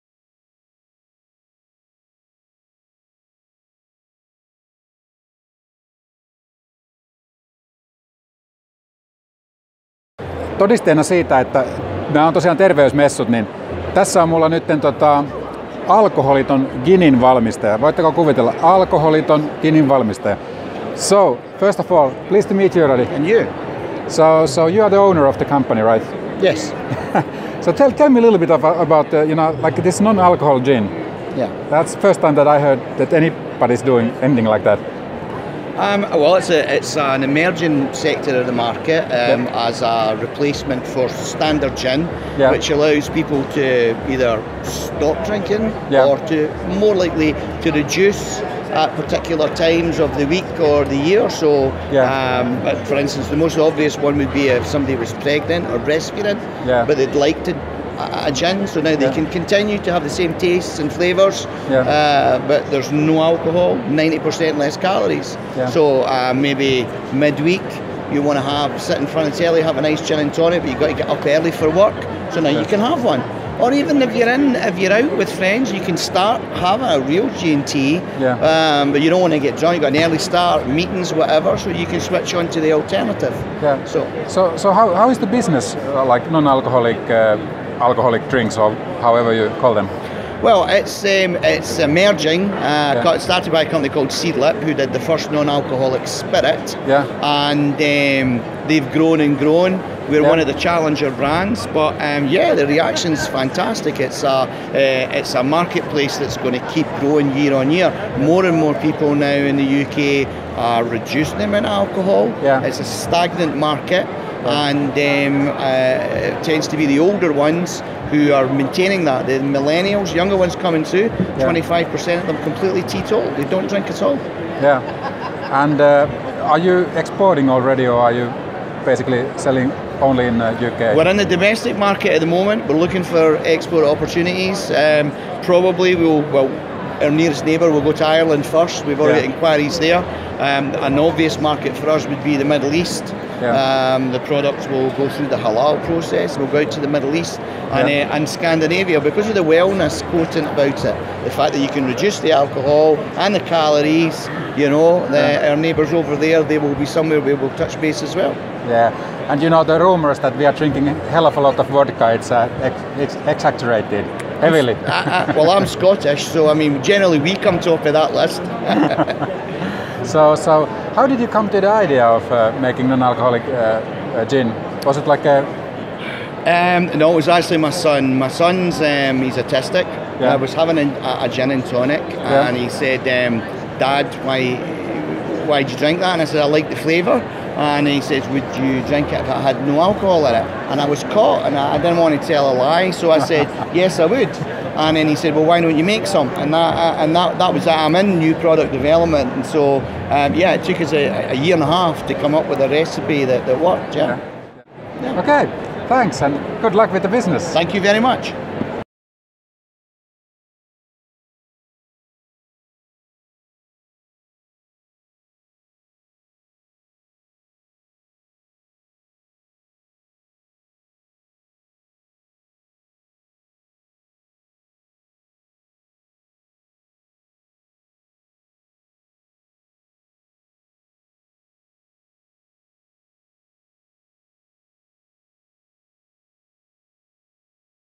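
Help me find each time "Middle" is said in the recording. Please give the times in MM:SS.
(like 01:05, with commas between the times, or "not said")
02:22, 02:26.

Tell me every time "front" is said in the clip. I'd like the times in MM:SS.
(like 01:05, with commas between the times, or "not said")
01:09.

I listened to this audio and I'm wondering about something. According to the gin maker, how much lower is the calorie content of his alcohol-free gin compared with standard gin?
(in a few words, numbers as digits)
90% less calories.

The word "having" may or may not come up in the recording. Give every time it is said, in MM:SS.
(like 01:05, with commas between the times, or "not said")
01:16, 03:00.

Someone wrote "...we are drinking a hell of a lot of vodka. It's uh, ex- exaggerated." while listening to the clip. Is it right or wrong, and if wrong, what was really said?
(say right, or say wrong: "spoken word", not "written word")
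right.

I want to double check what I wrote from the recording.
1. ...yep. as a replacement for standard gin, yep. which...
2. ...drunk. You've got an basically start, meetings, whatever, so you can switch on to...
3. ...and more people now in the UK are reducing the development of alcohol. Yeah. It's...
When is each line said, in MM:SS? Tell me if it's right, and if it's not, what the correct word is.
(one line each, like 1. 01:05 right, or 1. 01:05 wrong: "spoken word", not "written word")
1. 00:39 right
2. 01:19 wrong: "early", not "basically"
3. 01:48 wrong: "amount", not "development".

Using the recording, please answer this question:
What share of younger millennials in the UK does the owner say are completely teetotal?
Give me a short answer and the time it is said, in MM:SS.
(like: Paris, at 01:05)
25%, at 02:01.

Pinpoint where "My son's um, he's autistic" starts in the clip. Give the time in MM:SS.
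02:58.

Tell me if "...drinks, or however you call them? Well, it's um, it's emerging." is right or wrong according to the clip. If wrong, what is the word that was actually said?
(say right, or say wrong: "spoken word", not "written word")
right.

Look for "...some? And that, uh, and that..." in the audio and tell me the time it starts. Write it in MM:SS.
03:16.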